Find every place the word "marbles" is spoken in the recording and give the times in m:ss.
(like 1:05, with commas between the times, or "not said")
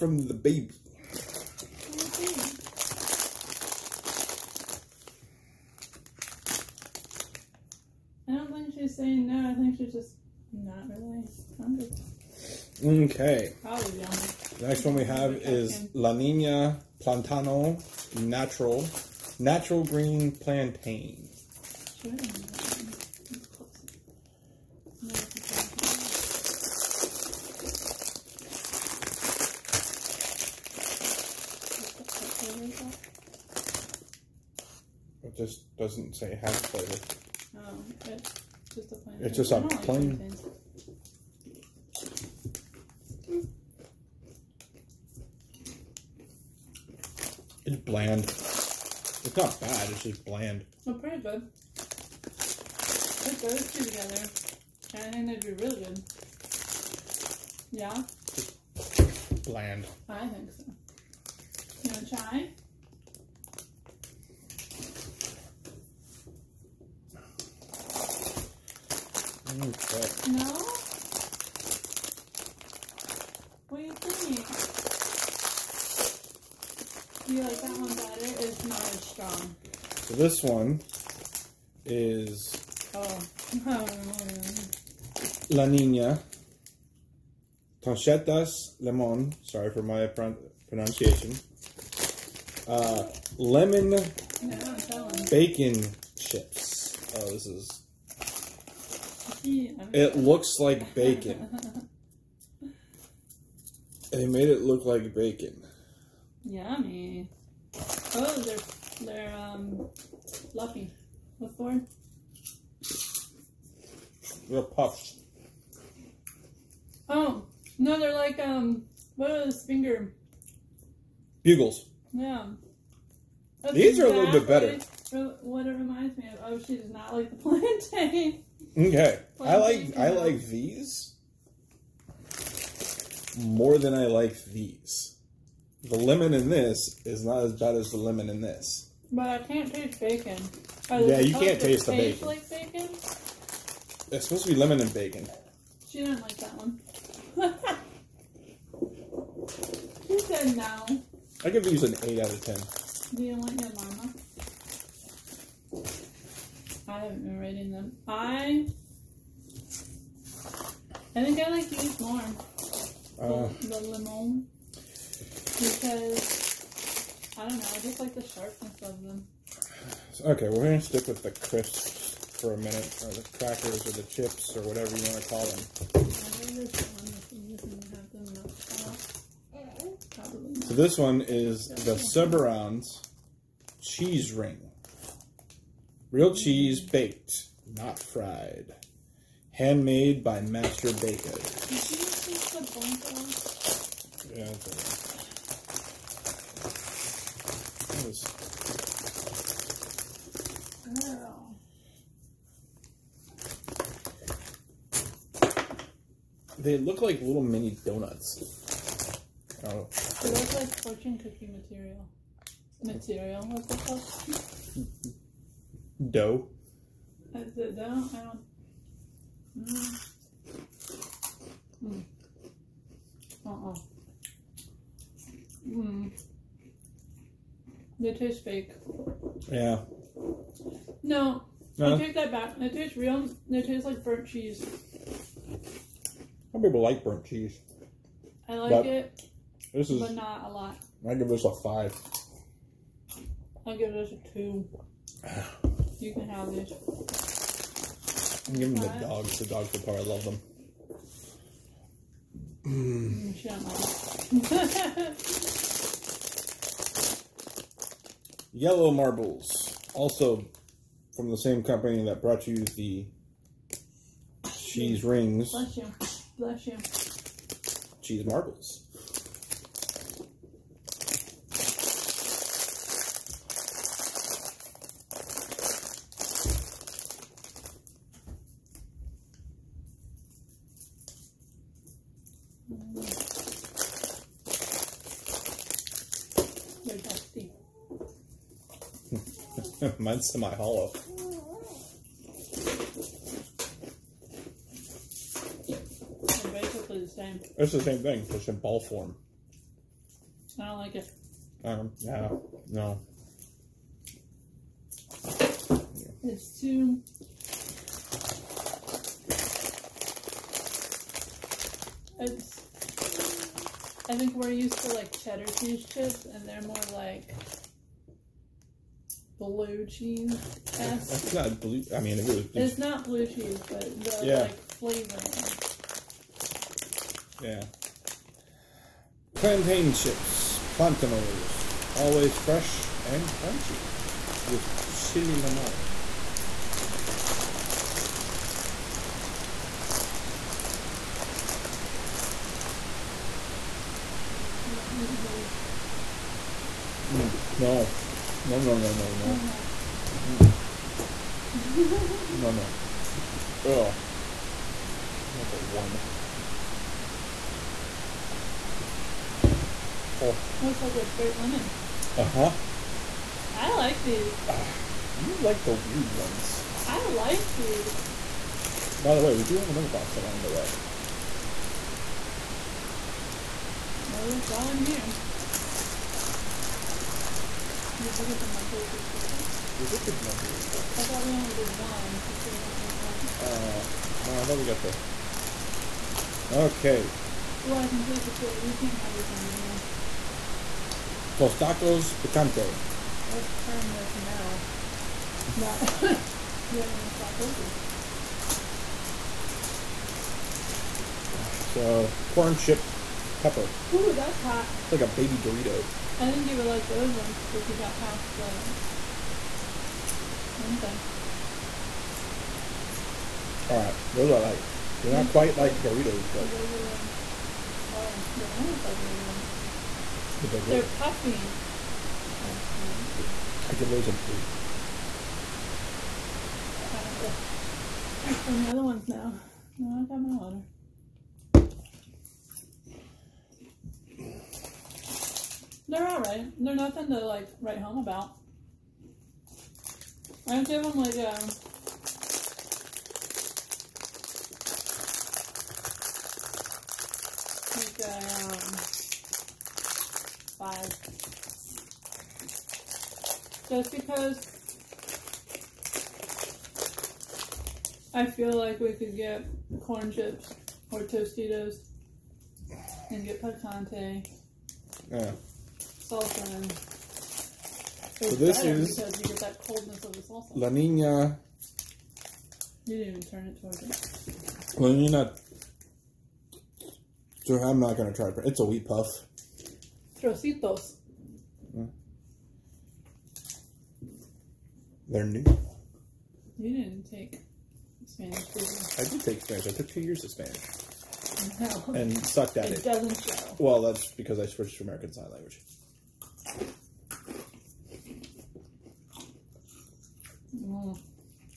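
4:18, 4:28.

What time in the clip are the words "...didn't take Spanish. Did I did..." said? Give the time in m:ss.
8:06.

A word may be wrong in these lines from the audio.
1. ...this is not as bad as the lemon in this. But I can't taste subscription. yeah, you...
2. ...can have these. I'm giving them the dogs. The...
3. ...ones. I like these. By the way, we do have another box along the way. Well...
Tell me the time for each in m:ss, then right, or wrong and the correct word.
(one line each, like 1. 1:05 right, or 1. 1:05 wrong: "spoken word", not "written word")
1. 2:16 wrong: "bacon", not "subscription"
2. 4:06 right
3. 6:06 right.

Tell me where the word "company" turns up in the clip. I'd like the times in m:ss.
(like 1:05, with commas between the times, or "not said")
4:21.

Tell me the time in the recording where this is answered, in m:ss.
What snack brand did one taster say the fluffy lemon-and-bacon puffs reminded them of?
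2:01.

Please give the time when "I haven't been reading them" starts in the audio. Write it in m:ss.
2:36.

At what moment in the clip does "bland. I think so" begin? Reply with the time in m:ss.
0:59.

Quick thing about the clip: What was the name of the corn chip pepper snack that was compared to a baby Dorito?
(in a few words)
Tostacos Picante.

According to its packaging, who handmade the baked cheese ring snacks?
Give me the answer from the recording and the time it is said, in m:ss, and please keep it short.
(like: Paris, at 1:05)
Master Baker, at 3:10.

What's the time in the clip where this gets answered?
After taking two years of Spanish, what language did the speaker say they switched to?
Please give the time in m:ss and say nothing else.
8:14.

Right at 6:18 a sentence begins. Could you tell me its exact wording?
Did you get the monthly subscription?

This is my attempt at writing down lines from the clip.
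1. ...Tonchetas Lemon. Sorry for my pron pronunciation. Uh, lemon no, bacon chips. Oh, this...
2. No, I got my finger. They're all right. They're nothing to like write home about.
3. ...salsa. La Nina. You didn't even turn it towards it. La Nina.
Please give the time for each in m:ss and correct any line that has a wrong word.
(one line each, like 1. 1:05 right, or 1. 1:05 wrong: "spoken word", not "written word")
1. 1:27 right
2. 7:09 wrong: "water", not "finger"
3. 7:50 right.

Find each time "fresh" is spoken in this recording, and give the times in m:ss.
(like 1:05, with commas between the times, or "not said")
5:32.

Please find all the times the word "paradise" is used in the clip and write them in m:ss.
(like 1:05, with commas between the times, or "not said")
not said.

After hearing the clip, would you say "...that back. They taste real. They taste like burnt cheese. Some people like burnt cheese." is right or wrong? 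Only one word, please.
right.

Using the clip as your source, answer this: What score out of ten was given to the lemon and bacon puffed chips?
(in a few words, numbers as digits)
8.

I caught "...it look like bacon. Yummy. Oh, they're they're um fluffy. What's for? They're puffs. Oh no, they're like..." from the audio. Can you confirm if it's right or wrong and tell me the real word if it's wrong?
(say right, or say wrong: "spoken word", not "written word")
right.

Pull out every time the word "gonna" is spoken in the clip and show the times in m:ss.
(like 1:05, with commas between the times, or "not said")
2:50, 7:57.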